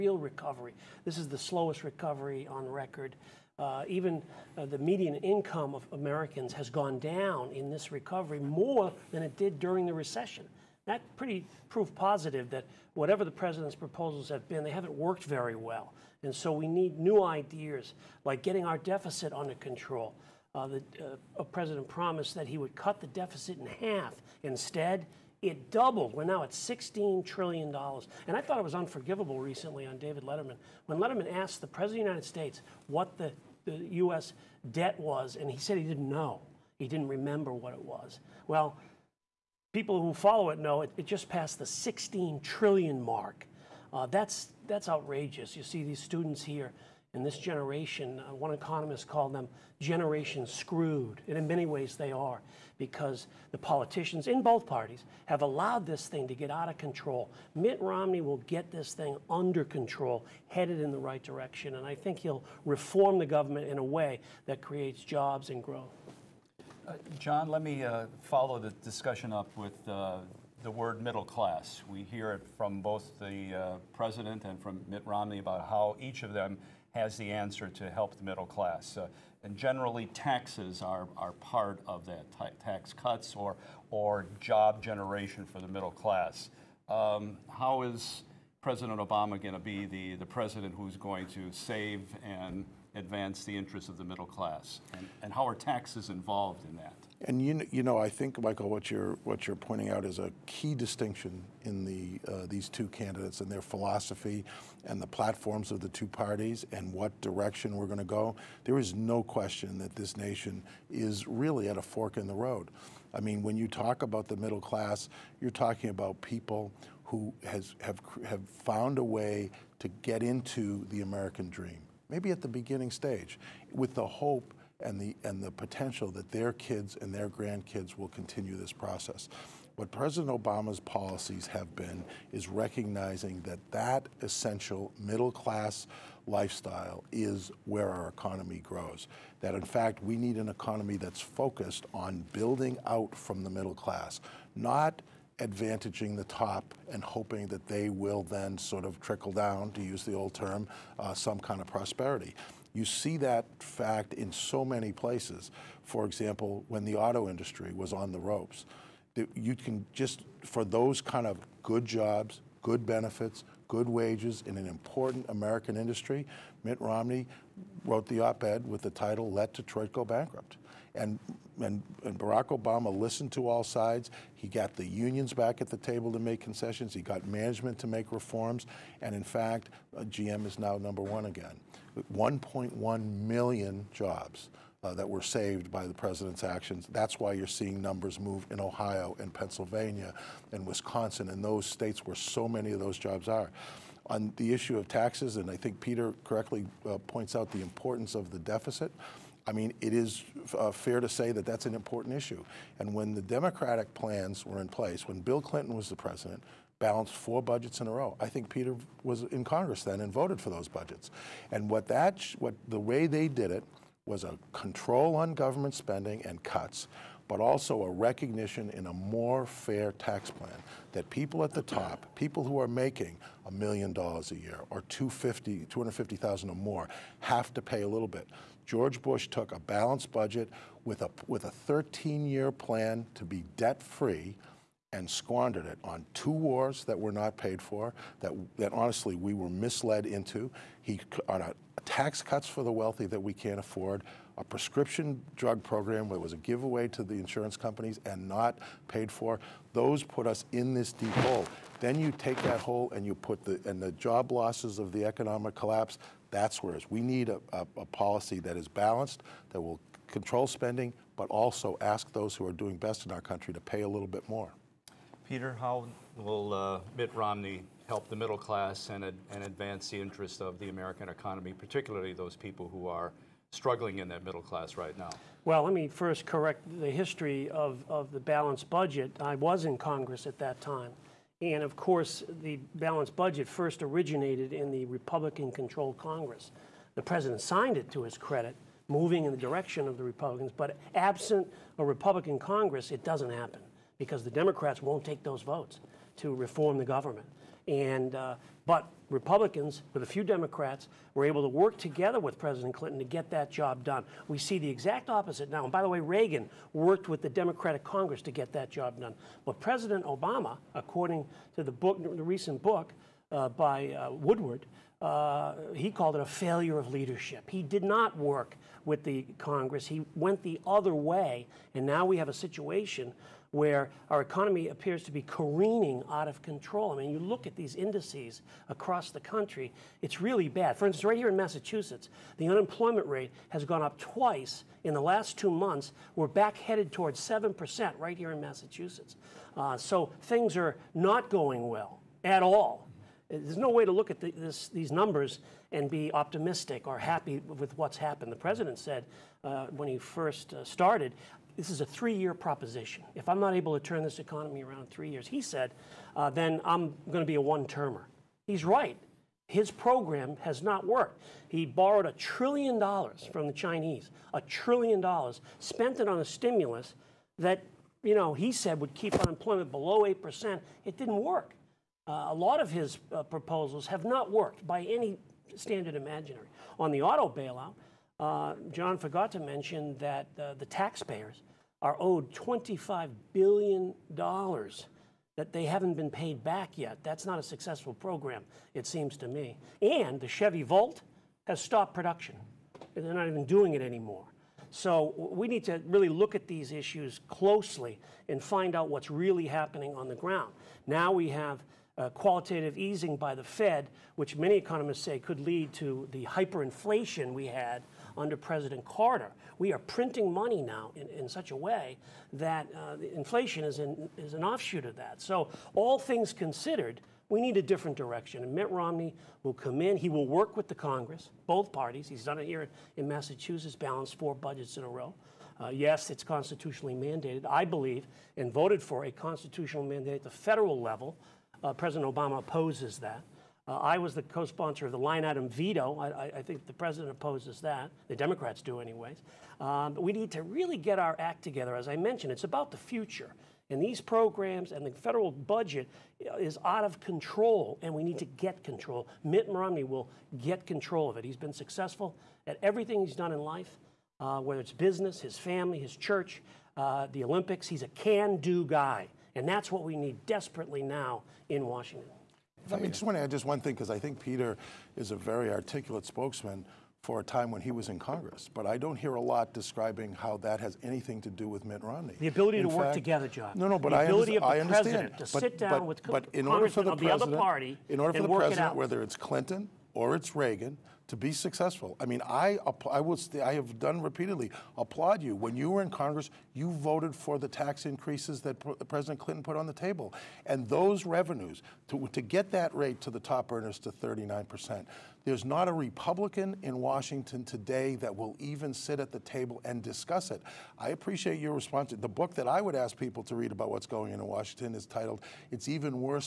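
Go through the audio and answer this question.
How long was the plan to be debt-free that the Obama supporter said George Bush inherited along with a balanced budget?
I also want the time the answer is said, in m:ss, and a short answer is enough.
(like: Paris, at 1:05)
13 years, at 3:51.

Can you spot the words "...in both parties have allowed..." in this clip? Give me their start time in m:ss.
0:54.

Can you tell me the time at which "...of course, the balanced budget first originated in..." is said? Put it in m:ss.
4:41.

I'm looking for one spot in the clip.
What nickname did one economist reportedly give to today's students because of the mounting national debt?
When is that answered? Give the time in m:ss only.
0:49.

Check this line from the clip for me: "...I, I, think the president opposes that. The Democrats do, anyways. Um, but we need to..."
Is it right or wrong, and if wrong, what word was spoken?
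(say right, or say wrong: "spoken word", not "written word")
right.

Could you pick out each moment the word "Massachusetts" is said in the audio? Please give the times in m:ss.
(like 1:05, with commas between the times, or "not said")
5:31, 5:38, 7:03.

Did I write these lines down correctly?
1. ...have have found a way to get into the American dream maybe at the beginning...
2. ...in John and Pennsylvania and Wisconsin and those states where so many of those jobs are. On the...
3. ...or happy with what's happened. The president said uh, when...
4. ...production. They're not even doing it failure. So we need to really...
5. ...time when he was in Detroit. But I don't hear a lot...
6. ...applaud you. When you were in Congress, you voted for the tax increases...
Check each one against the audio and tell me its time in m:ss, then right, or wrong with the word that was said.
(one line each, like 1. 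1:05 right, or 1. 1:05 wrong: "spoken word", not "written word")
1. 1:57 right
2. 3:08 wrong: "Ohio", not "John"
3. 5:46 right
4. 6:31 wrong: "anymore", not "failure"
5. 7:47 wrong: "Congress", not "Detroit"
6. 8:04 right.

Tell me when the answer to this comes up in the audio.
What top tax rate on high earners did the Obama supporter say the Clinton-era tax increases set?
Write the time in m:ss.
8:13.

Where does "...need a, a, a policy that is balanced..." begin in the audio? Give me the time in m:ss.
4:17.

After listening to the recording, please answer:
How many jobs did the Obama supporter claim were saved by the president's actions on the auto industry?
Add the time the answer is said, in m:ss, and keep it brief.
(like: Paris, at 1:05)
1.1 million, at 3:02.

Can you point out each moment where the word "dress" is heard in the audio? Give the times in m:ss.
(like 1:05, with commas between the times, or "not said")
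not said.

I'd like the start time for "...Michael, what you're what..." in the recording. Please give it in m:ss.
1:38.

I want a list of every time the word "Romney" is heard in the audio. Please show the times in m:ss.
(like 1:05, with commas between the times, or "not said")
0:57, 1:15, 2:46, 4:27, 6:58, 7:29, 7:51.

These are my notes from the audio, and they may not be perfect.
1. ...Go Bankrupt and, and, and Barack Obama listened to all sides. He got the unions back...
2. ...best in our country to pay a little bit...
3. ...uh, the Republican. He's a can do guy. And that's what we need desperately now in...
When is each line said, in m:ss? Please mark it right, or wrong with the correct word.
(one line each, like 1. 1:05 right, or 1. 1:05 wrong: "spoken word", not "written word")
1. 2:49 right
2. 4:22 right
3. 7:36 wrong: "Olympics", not "Republican".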